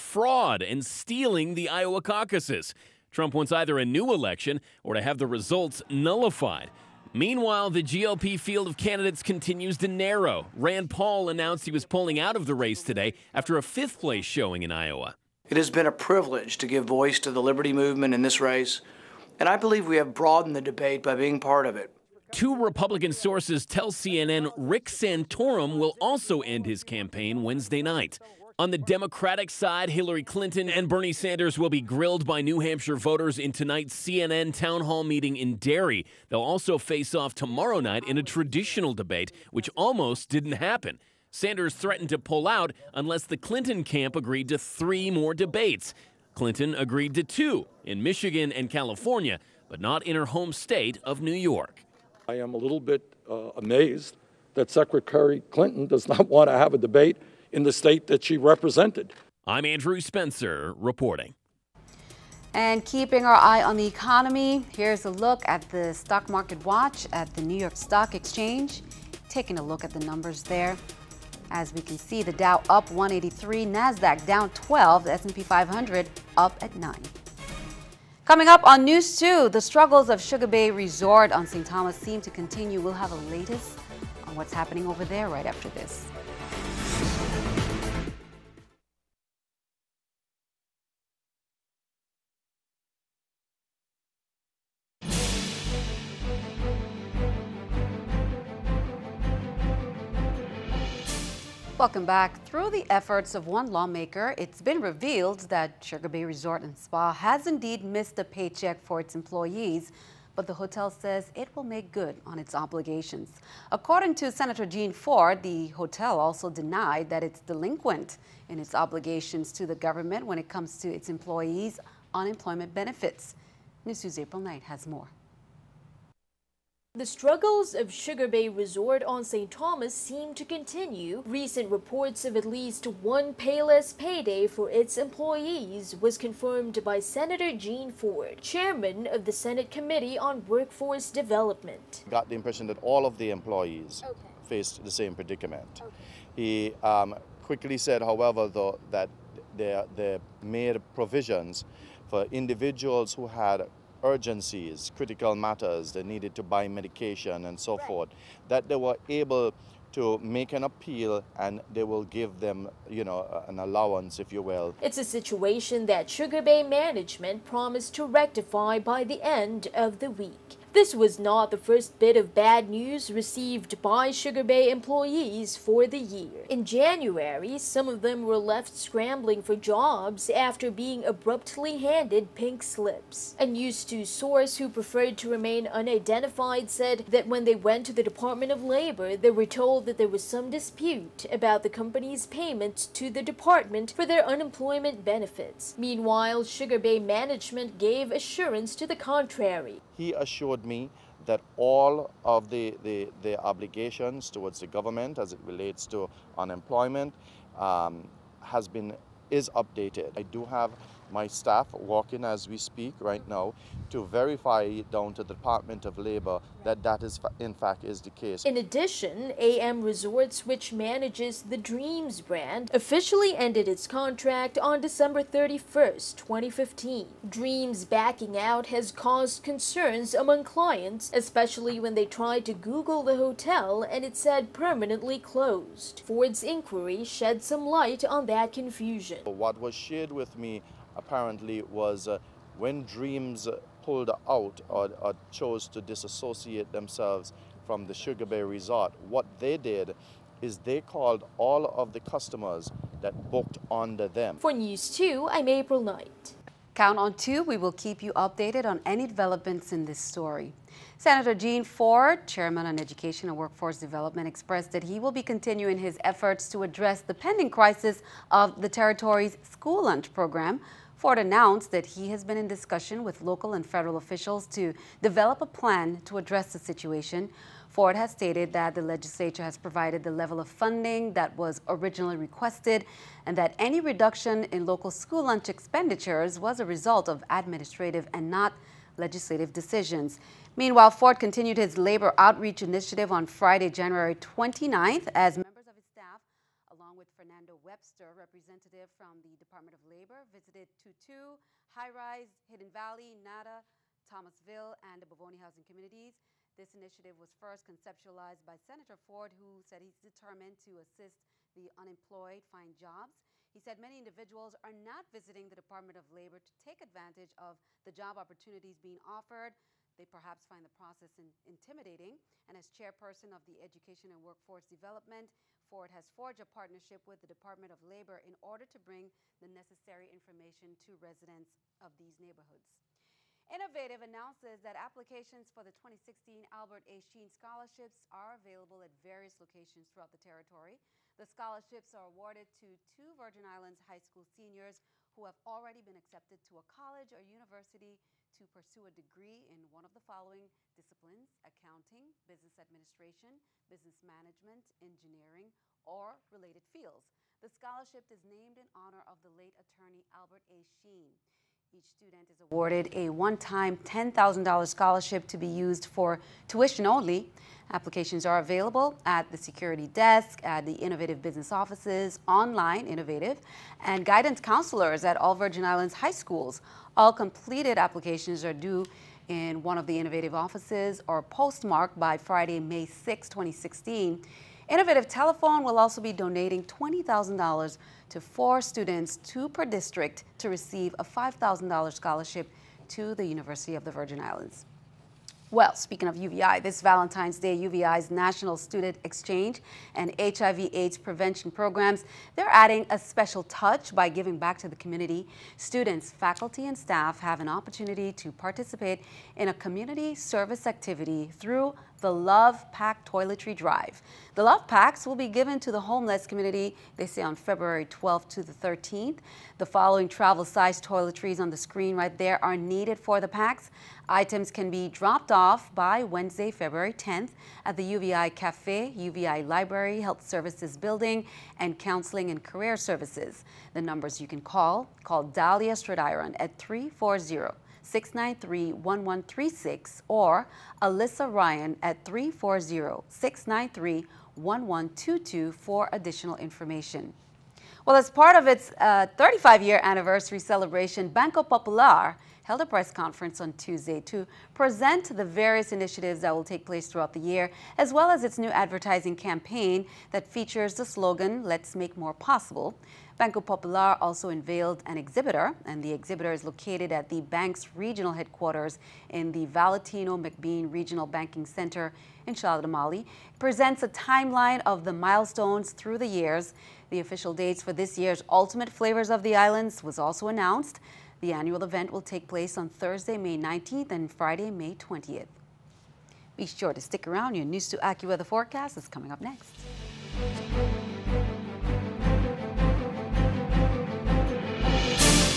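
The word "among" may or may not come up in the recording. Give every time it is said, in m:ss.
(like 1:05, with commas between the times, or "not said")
3:50.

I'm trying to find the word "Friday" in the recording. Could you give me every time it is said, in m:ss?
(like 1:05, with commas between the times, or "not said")
4:53, 6:22, 8:04.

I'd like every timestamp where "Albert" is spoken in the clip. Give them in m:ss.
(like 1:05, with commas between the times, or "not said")
5:36, 6:00.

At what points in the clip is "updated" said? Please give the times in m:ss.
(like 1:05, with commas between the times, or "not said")
3:29, 4:18.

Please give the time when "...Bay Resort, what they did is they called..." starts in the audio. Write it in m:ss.
4:08.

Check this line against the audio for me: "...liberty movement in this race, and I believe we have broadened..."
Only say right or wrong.
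right.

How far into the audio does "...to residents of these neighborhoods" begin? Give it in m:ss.
5:30.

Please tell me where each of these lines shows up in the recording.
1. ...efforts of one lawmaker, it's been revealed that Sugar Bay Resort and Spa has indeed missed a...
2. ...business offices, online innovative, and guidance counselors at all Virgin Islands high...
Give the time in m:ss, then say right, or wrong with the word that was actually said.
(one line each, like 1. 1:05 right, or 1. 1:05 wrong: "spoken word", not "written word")
1. 1:42 right
2. 6:11 right.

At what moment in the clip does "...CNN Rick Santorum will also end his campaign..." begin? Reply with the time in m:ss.
0:23.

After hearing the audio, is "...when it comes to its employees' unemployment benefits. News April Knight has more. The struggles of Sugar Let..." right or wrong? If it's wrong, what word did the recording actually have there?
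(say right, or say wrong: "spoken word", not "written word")
wrong: "Bay", not "Let".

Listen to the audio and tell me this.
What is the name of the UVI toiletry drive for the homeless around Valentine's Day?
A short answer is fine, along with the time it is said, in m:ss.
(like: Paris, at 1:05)
Love Pack Toiletry Drive, at 6:52.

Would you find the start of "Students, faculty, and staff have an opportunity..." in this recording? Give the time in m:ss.
6:45.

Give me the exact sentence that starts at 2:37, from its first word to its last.
forth, that they were able to make an appeal and they will give them, you know, an allowance, if you will.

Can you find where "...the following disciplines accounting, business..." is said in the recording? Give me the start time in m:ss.
5:49.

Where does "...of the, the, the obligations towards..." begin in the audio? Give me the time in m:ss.
3:22.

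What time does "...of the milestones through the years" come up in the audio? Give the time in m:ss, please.
7:54.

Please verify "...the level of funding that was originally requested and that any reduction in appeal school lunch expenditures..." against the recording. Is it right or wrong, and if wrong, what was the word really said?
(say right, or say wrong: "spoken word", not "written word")
wrong: "local", not "appeal".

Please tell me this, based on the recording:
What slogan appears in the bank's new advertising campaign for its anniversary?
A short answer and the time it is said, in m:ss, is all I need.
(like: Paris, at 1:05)
Let's Make More Possible, at 7:41.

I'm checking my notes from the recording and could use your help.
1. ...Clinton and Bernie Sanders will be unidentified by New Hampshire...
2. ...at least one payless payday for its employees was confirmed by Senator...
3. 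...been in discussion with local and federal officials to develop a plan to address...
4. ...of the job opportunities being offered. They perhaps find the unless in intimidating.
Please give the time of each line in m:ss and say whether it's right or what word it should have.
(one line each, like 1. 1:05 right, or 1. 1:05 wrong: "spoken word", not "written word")
1. 0:30 wrong: "grilled", not "unidentified"
2. 2:12 right
3. 4:32 right
4. 5:17 wrong: "process", not "unless".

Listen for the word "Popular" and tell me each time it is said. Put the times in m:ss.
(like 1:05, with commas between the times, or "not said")
7:31, 7:43.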